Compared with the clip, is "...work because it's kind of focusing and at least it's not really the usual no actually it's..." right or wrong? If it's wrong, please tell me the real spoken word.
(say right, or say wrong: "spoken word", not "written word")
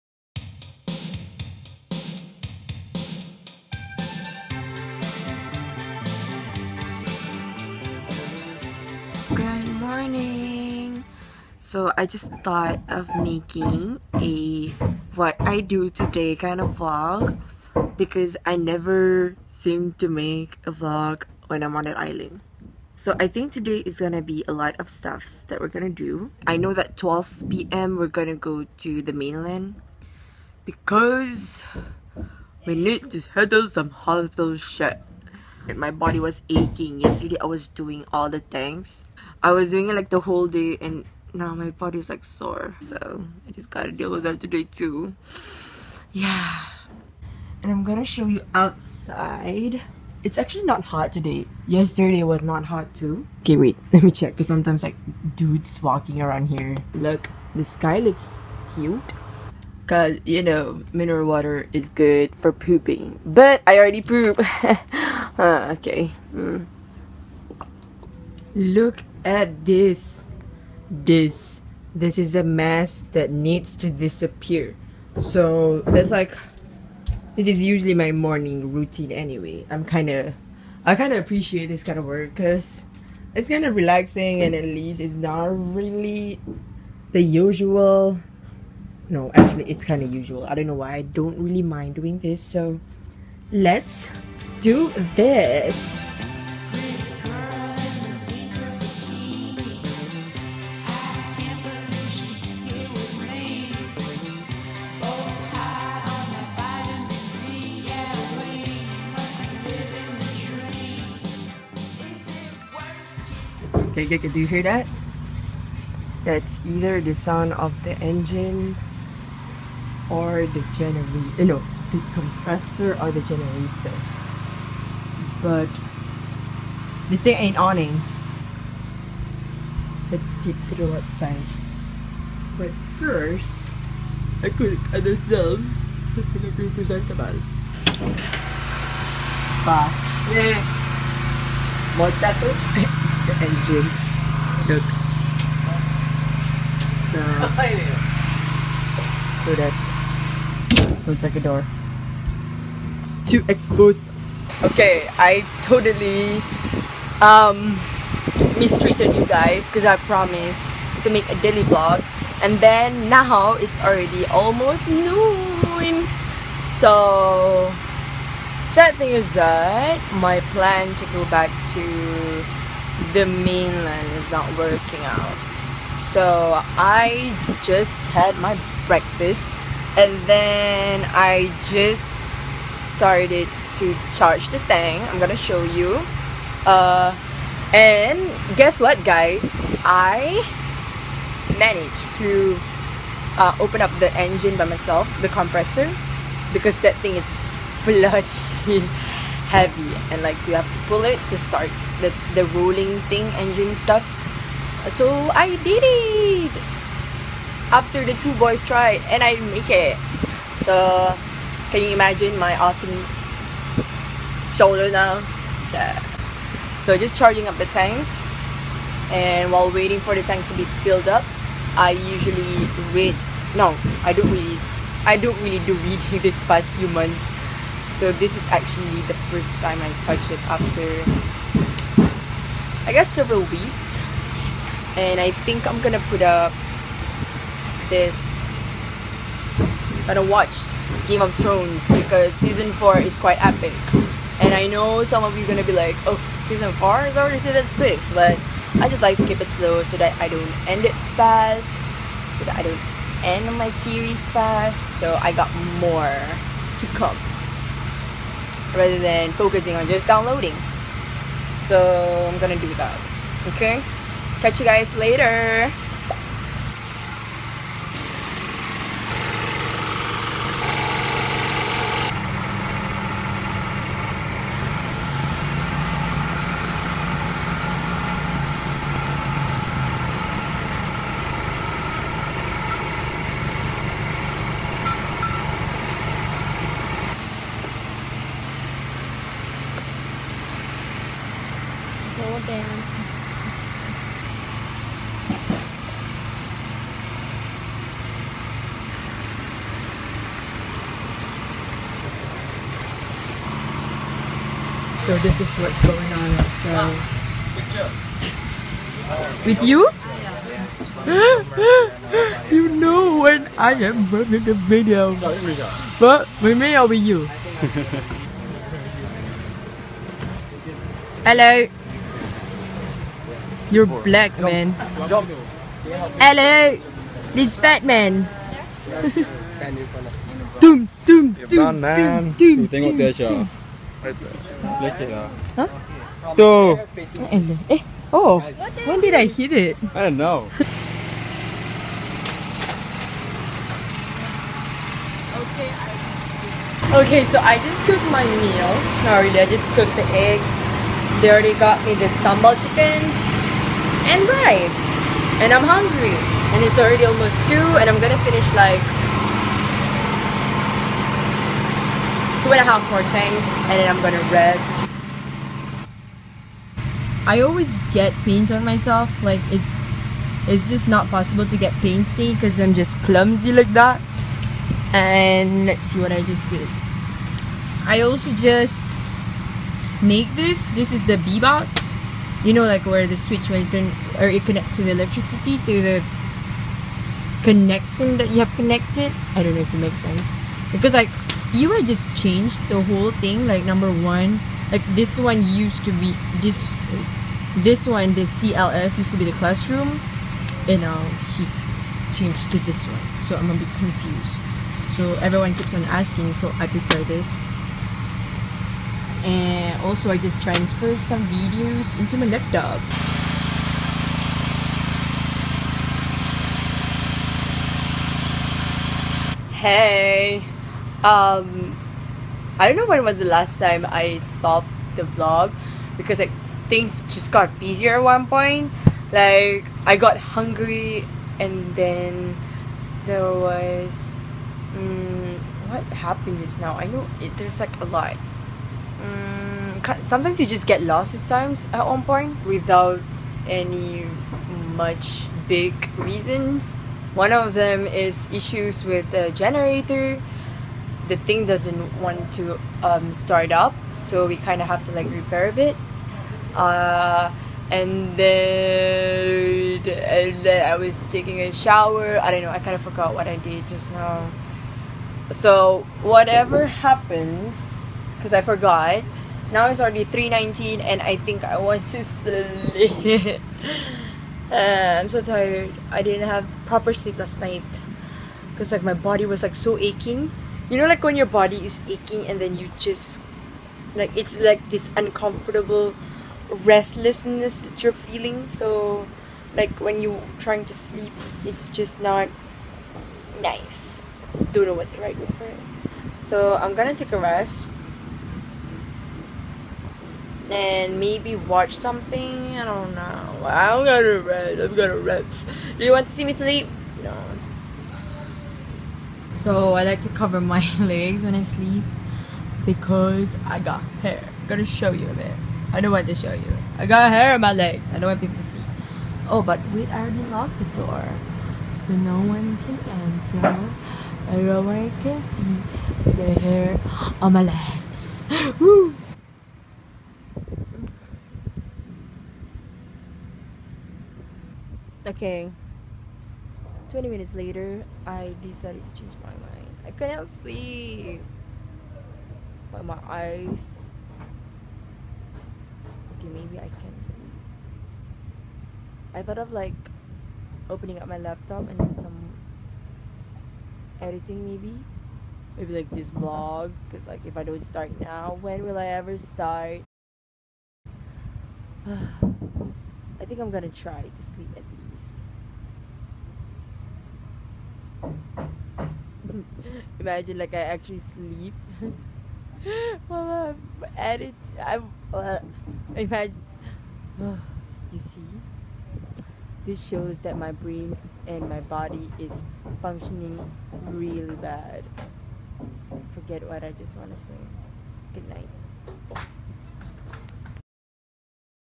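wrong: "relaxing", not "focusing".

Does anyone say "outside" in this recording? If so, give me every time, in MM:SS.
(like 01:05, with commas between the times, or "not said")
00:48, 02:10.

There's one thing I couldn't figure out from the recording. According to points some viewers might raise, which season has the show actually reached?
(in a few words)
Season 6.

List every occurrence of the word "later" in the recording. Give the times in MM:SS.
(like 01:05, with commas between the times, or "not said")
04:24, 08:57.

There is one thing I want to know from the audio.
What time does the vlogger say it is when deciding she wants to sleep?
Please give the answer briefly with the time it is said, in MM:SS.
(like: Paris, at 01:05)
3:19, at 07:50.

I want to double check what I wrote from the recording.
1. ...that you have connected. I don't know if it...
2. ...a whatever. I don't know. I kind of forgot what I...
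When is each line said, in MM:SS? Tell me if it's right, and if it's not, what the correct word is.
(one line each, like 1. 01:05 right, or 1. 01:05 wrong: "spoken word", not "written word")
1. 06:28 right
2. 07:41 wrong: "shower", not "whatever".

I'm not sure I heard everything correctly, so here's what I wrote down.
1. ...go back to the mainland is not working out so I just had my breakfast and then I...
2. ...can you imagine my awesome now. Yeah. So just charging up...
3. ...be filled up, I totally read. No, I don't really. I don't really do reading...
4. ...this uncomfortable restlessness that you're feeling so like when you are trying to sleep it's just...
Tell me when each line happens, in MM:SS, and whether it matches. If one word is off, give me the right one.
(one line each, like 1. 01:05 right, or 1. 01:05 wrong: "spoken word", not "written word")
1. 02:51 right
2. 03:31 right
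3. 03:40 wrong: "usually", not "totally"
4. 08:04 right.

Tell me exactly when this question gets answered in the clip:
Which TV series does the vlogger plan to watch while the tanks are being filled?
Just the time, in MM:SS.
04:01.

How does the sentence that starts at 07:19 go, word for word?
Um, sometimes you just get lost with times at one point without any much big reasons.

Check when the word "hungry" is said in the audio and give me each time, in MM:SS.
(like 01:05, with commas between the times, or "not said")
05:55, 07:10.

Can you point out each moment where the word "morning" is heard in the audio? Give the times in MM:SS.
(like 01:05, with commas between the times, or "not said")
00:10, 01:18.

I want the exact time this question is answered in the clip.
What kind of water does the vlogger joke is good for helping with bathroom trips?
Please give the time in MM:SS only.
01:00.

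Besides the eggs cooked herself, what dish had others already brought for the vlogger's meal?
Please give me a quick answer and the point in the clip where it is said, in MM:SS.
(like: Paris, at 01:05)
Sambal chicken and rice, at 05:52.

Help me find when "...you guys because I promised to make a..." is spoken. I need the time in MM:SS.
02:39.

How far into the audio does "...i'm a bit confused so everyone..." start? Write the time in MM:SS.
06:43.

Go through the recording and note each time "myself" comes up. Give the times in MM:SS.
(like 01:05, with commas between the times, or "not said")
03:14, 06:08.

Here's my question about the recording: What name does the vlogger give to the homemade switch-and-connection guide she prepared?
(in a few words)
B-box.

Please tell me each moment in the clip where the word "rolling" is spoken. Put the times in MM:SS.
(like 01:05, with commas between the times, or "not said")
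03:22.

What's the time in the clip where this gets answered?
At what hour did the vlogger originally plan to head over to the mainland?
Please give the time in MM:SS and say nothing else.
00:26.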